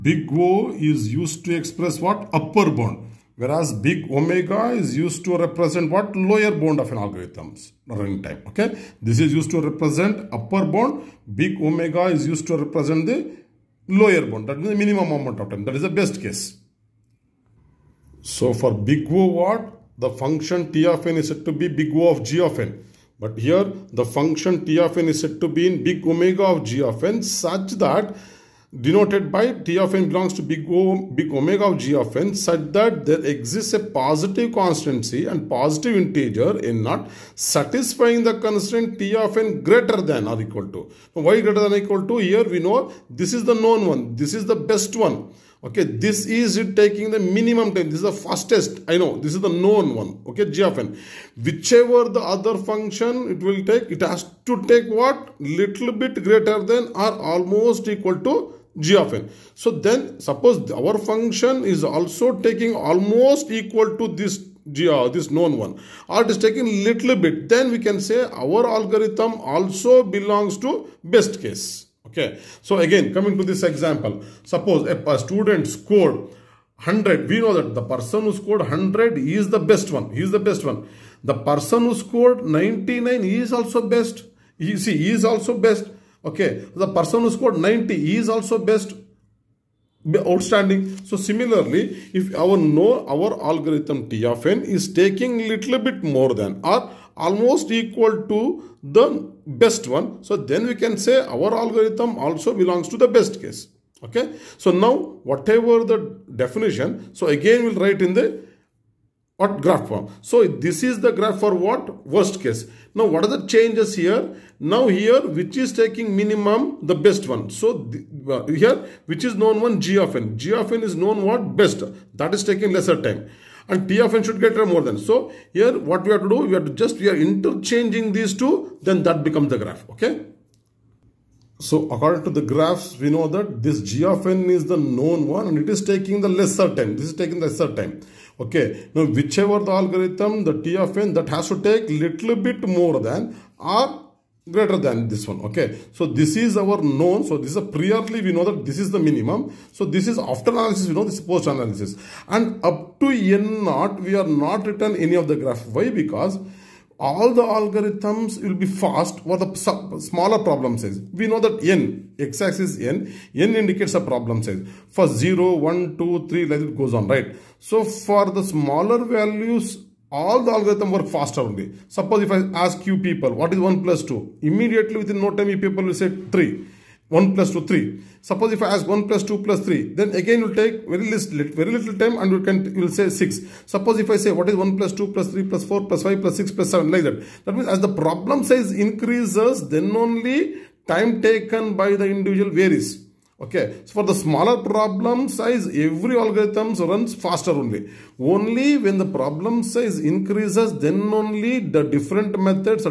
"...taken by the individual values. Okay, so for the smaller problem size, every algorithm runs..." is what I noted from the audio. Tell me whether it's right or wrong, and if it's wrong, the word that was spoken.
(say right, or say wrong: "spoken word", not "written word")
wrong: "varies", not "values".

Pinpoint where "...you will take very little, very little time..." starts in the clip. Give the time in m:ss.
3:00.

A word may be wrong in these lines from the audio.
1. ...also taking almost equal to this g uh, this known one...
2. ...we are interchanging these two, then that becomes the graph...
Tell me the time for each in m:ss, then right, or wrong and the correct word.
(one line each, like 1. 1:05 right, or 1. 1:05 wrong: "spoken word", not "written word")
1. 1:01 right
2. 2:06 right.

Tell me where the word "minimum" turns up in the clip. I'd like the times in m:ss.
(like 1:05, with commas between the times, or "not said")
0:14, 0:47, 1:56, 2:28.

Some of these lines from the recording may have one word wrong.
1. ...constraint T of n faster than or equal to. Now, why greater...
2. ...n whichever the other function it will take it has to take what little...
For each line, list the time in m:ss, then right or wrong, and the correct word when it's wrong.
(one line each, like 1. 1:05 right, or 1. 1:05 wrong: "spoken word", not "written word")
1. 0:38 wrong: "greater", not "faster"
2. 0:50 right.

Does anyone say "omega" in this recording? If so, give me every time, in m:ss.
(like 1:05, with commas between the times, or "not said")
0:04, 0:11, 0:26, 0:31.